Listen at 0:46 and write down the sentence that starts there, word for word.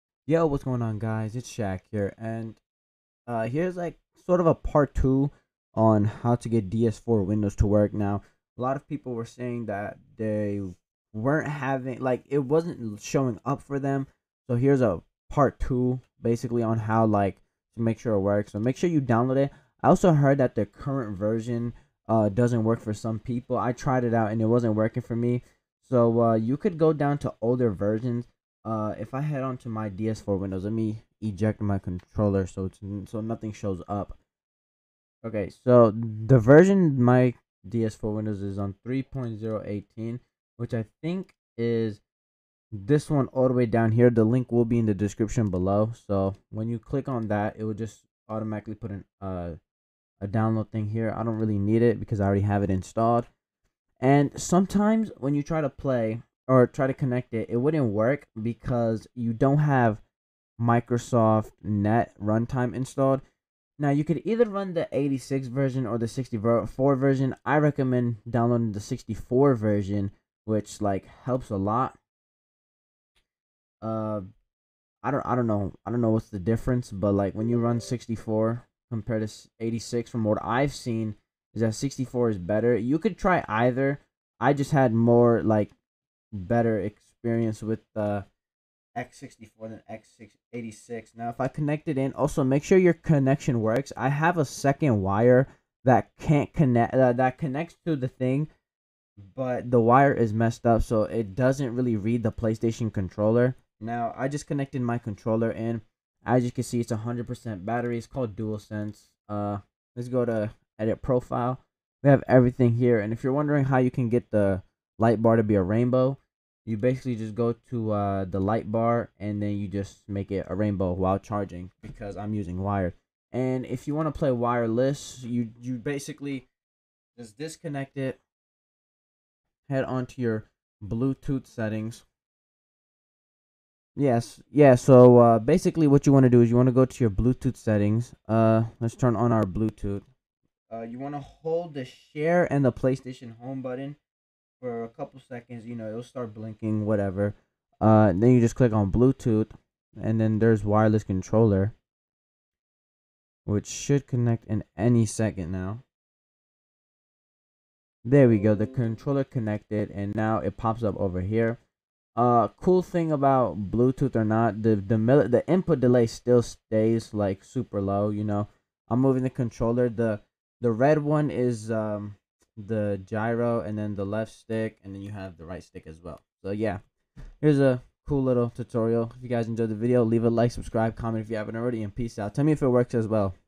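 So when you click on that, it will just automatically put an uh, a download thing here.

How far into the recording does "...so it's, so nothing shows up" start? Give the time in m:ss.
0:32.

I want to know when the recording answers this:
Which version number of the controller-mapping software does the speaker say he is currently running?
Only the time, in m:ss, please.
0:38.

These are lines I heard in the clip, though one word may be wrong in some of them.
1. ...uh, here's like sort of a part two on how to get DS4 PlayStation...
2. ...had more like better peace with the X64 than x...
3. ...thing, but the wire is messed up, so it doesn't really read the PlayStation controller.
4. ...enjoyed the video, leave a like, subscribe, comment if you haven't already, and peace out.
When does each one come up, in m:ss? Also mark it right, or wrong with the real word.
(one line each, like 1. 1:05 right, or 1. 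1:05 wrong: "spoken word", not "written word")
1. 0:03 wrong: "Windows", not "PlayStation"
2. 1:24 wrong: "experience", not "peace"
3. 1:38 right
4. 2:59 right.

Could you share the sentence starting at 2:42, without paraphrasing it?
Uh, cool thing about Bluetooth or not, the the the input delay still stays like super low.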